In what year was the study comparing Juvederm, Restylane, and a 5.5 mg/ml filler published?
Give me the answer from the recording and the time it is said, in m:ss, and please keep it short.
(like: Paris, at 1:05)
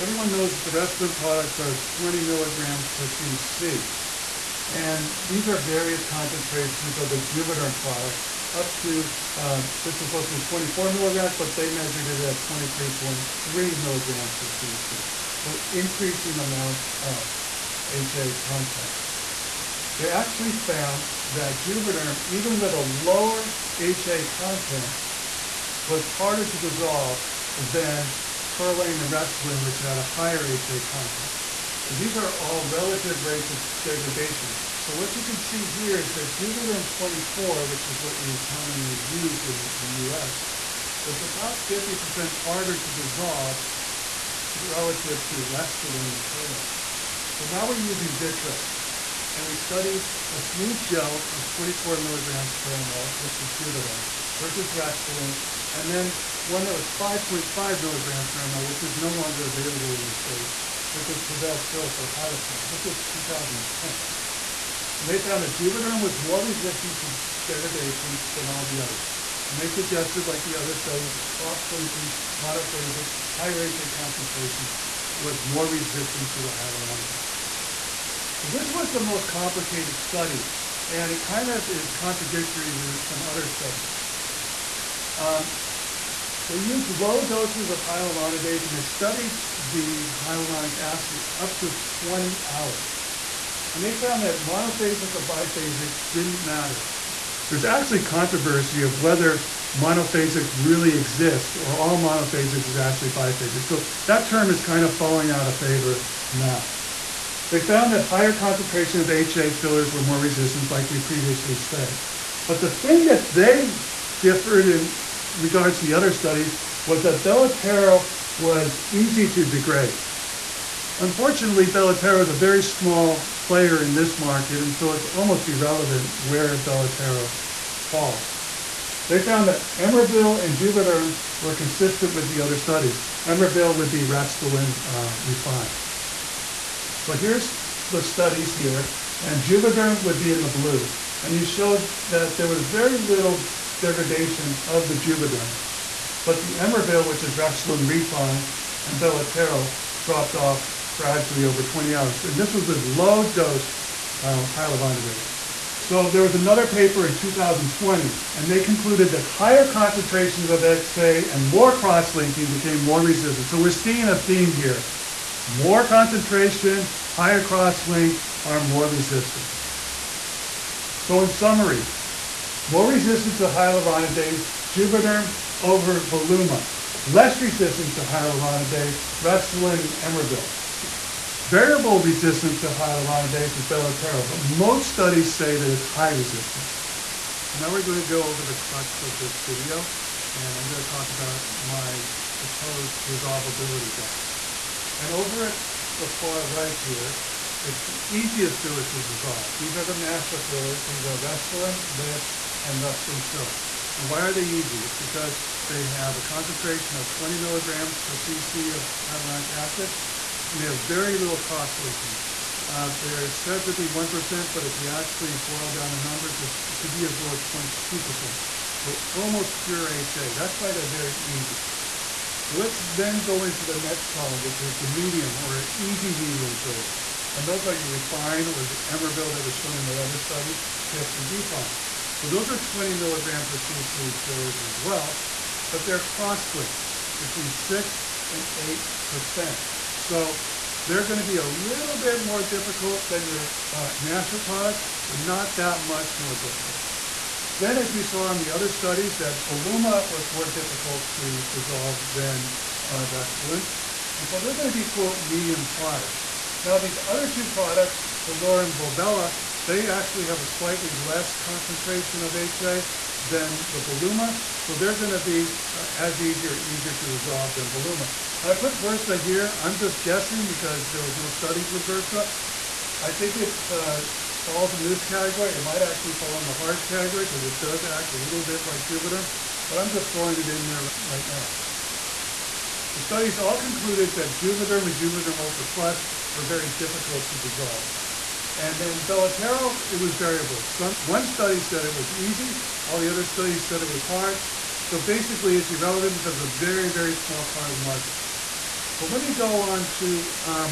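2010, at 1:03.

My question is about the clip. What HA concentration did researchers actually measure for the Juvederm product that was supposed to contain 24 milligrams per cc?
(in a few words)
23.3 milligrams per cc.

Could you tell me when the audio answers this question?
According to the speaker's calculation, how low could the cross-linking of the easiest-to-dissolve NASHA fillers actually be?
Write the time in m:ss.
3:37.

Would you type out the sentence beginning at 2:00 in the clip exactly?
Unfortunately, Belotero is a very small player in this market, and so it's almost irrelevant where Belotero falls.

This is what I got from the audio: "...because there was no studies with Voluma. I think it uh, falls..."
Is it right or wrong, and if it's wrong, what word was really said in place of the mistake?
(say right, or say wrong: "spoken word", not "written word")
wrong: "Versa", not "Voluma".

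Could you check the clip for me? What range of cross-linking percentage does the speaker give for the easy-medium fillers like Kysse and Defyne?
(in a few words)
6 to 8%.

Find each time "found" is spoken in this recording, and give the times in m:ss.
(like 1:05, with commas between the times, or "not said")
0:20, 1:05, 1:33, 1:47, 2:09.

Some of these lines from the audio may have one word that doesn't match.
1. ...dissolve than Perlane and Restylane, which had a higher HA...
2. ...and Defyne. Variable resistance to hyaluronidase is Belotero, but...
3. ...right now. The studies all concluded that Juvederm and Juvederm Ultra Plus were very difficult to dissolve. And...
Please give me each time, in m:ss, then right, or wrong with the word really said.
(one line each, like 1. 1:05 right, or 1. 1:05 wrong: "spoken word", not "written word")
1. 0:26 right
2. 2:59 wrong: "Emervel", not "Defyne"
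3. 4:41 right.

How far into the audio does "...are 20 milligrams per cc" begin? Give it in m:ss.
0:01.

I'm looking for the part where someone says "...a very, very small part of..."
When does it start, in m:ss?
4:56.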